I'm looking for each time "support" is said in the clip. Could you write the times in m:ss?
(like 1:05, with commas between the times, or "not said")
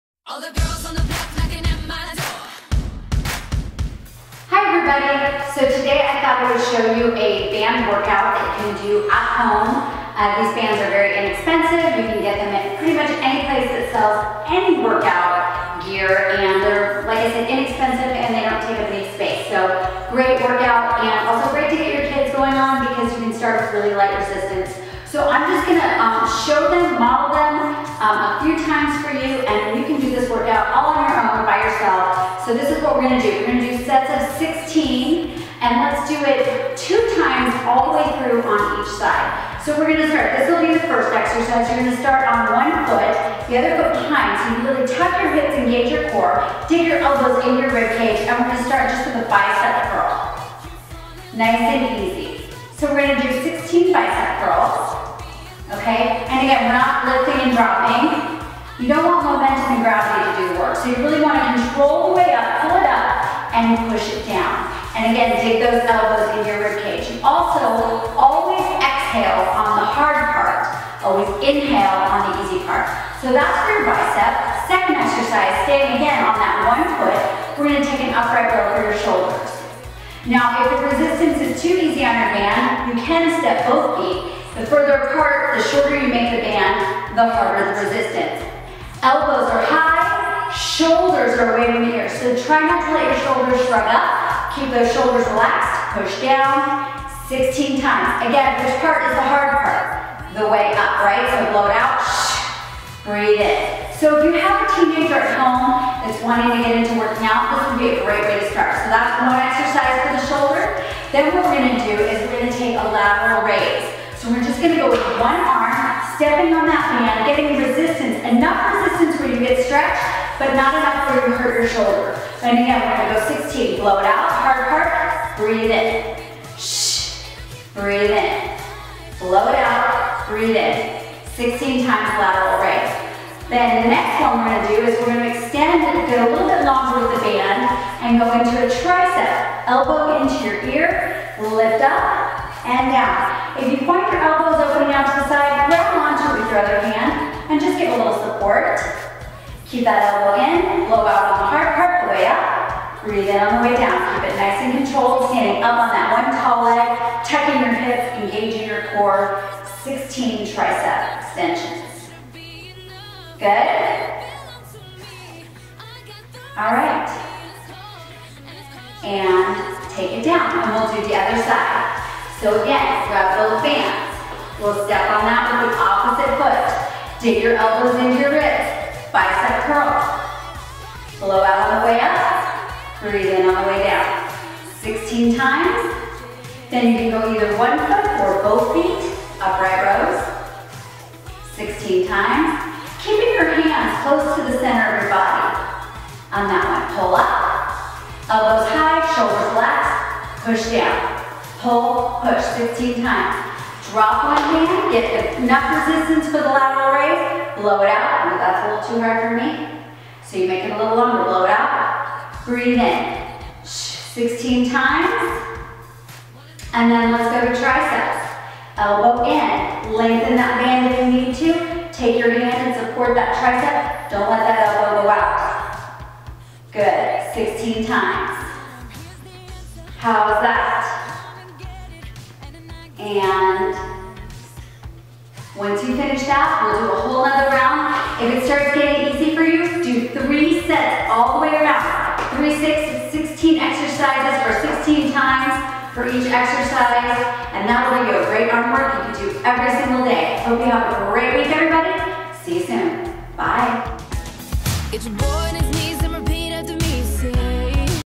2:28, 3:42.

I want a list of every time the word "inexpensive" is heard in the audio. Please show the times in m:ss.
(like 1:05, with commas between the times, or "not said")
0:11, 0:17.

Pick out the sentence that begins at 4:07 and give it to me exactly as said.
And that will give you a great arm work you can do every single day.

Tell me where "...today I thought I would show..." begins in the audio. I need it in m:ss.
0:05.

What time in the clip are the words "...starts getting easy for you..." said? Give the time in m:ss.
3:58.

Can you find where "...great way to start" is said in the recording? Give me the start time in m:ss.
1:48.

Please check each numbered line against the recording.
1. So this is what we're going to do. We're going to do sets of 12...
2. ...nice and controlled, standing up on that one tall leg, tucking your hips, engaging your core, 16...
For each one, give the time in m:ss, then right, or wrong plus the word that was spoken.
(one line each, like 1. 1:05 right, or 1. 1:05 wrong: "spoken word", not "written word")
1. 0:32 wrong: "16", not "12"
2. 2:34 right.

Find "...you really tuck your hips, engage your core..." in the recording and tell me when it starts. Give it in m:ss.
0:44.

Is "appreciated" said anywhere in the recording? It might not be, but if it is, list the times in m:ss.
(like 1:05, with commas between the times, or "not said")
not said.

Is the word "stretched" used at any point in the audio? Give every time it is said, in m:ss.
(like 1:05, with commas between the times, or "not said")
1:59.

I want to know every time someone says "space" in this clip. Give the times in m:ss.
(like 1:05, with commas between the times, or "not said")
0:19.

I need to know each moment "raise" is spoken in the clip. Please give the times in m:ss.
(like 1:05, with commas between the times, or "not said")
1:53, 2:12, 3:26.